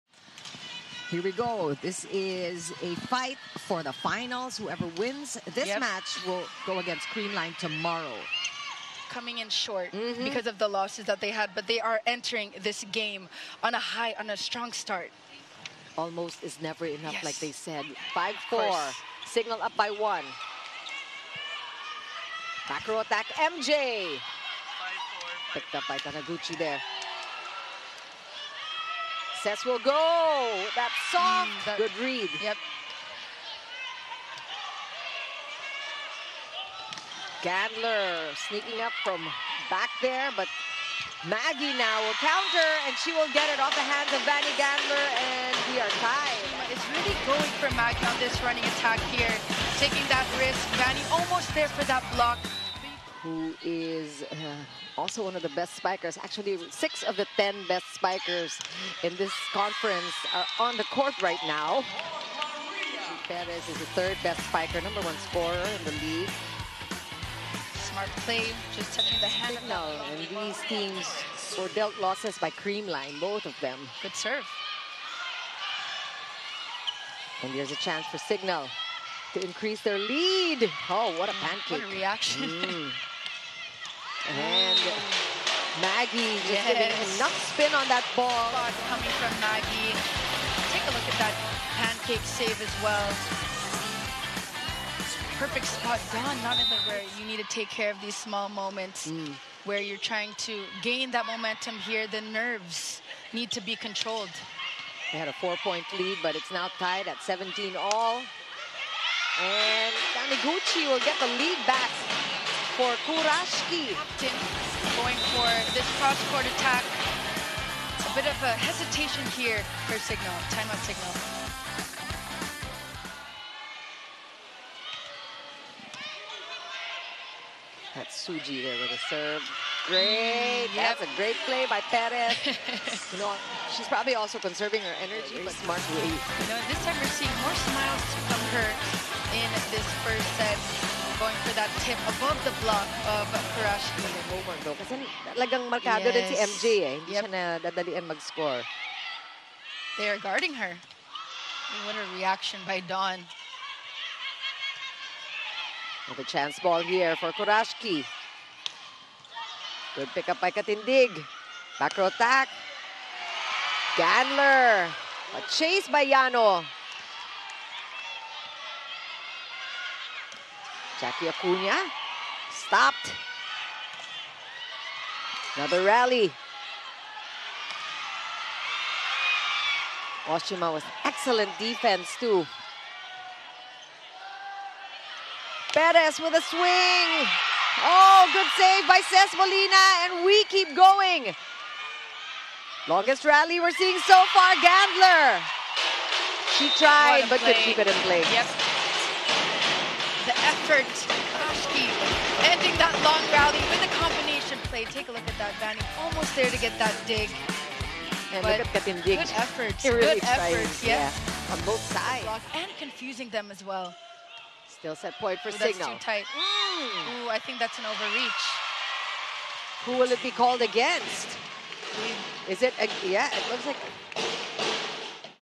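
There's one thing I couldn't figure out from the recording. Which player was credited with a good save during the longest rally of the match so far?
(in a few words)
Ces Molina.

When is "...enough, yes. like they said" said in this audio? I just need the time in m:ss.
0:16.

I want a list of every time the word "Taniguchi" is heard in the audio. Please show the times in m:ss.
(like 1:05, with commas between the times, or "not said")
0:26, 1:50.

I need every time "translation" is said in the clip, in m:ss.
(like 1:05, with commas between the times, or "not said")
not said.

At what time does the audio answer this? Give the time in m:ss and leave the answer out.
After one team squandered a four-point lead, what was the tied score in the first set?
1:47.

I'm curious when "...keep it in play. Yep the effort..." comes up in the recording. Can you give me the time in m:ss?
3:17.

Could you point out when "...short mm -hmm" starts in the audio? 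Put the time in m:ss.
0:09.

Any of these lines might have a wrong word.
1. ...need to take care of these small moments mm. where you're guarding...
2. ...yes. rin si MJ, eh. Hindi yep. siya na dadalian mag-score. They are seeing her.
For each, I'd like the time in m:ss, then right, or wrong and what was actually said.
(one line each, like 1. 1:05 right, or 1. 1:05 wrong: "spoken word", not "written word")
1. 1:37 wrong: "trying", not "guarding"
2. 2:26 wrong: "guarding", not "seeing".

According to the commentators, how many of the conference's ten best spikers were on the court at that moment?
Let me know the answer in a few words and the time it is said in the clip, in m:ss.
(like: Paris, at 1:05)
6, at 0:56.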